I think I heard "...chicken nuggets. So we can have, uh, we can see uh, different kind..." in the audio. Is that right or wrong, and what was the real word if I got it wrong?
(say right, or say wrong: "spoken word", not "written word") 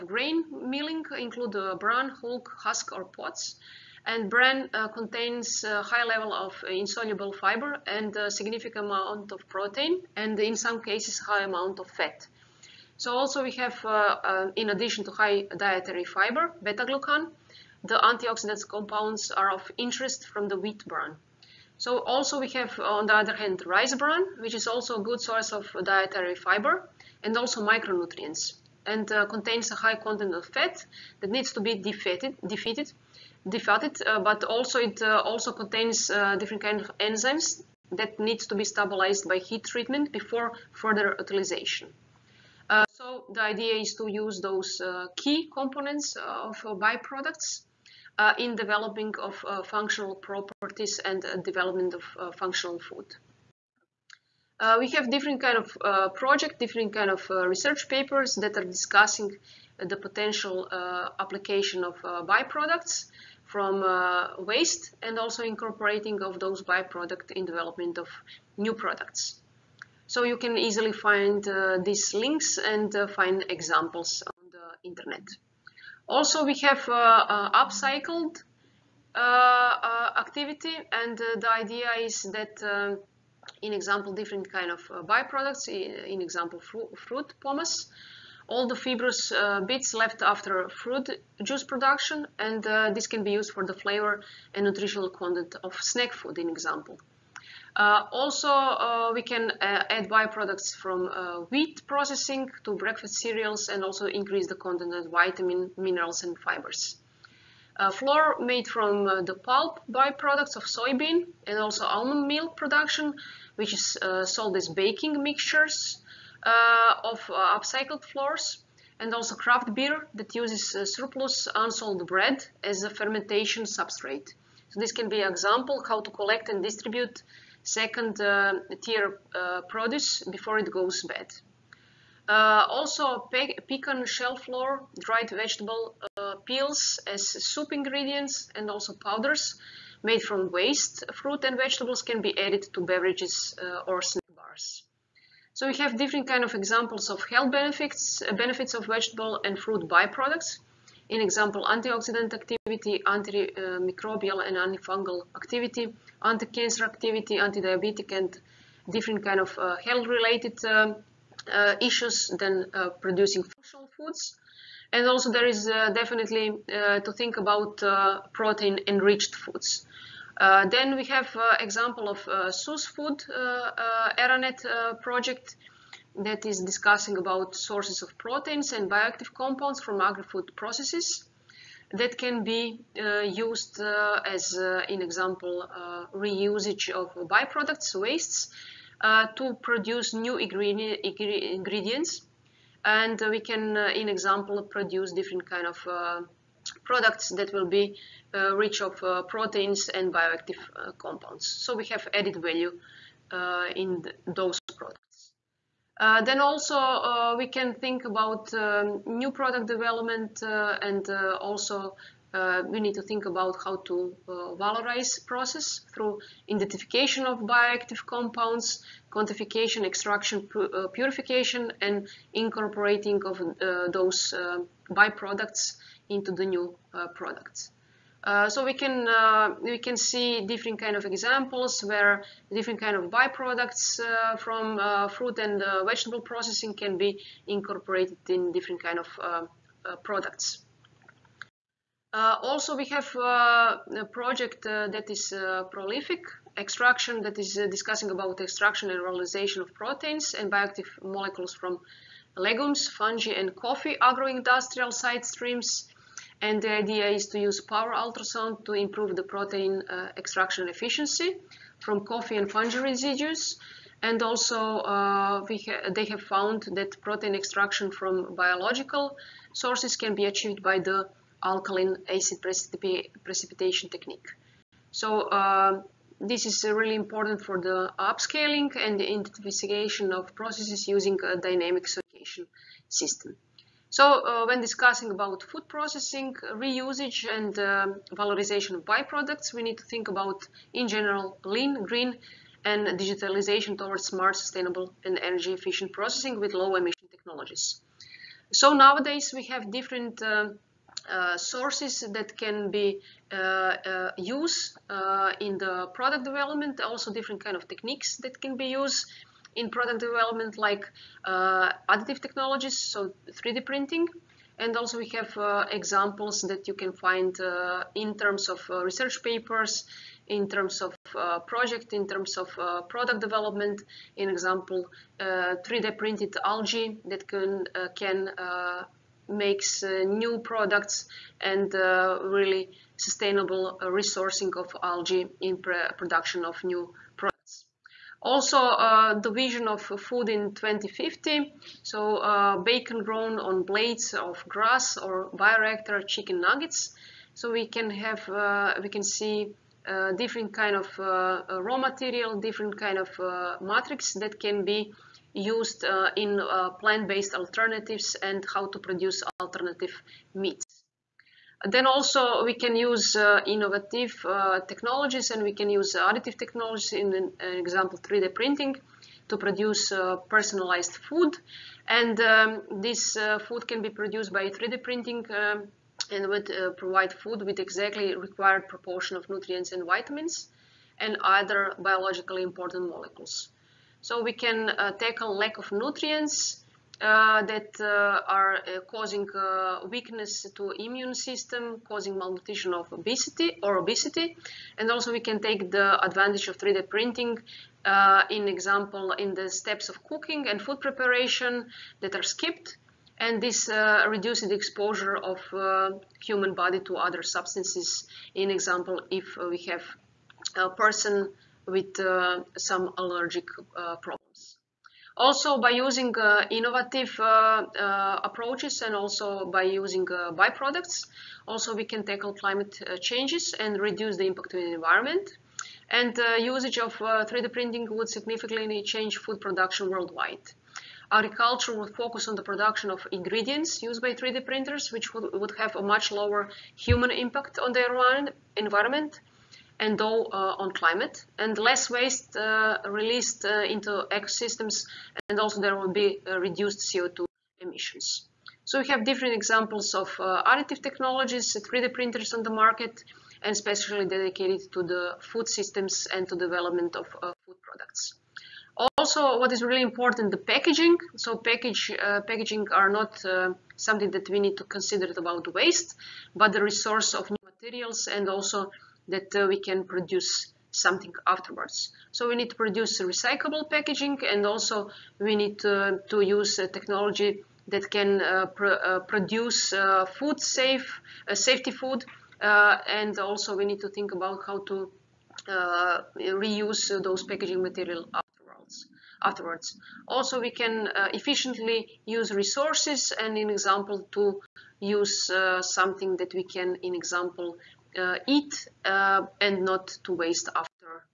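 right.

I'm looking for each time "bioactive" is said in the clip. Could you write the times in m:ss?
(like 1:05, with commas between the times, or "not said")
2:58, 3:20, 3:37, 4:10.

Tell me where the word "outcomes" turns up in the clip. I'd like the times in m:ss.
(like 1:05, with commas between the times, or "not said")
not said.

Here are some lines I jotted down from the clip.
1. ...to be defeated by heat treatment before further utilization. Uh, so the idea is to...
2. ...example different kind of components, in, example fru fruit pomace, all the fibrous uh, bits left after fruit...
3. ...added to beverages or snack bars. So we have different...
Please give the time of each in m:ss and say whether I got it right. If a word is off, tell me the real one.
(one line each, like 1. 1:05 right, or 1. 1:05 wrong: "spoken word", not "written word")
1. 0:38 wrong: "stabilized", not "defeated"
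2. 1:23 wrong: "byproducts", not "components"
3. 2:22 right.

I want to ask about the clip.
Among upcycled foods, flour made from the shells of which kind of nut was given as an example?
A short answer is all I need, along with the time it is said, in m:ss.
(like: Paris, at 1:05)
pecan, at 2:13.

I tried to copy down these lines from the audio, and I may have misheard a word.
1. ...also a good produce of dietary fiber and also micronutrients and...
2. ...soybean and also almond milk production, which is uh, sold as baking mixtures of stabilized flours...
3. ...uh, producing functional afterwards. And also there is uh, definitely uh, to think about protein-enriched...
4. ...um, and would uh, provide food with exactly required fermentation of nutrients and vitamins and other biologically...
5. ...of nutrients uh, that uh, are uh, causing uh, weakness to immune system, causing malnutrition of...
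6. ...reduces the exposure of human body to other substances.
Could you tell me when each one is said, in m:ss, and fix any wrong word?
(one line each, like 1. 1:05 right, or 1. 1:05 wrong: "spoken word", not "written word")
1. 0:24 wrong: "source", not "produce"
2. 1:50 wrong: "upcycled", not "stabilized"
3. 2:42 wrong: "foods", not "afterwards"
4. 6:15 wrong: "proportion", not "fermentation"
5. 6:25 right
6. 6:44 right.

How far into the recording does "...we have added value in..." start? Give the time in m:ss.
3:21.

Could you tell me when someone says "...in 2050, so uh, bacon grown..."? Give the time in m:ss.
5:40.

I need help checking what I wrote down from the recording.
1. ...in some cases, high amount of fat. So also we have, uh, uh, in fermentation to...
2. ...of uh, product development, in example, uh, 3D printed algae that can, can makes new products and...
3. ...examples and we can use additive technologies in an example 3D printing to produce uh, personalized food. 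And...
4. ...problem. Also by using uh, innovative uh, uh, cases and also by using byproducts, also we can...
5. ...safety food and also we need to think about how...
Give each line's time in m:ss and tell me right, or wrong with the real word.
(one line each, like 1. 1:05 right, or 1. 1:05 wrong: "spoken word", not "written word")
1. 0:10 wrong: "addition", not "fermentation"
2. 5:22 right
3. 6:04 wrong: "technologies", not "examples"
4. 6:54 wrong: "approaches", not "cases"
5. 8:01 right.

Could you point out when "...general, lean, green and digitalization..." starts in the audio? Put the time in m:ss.
4:50.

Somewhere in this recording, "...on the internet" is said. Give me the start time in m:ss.
1:14.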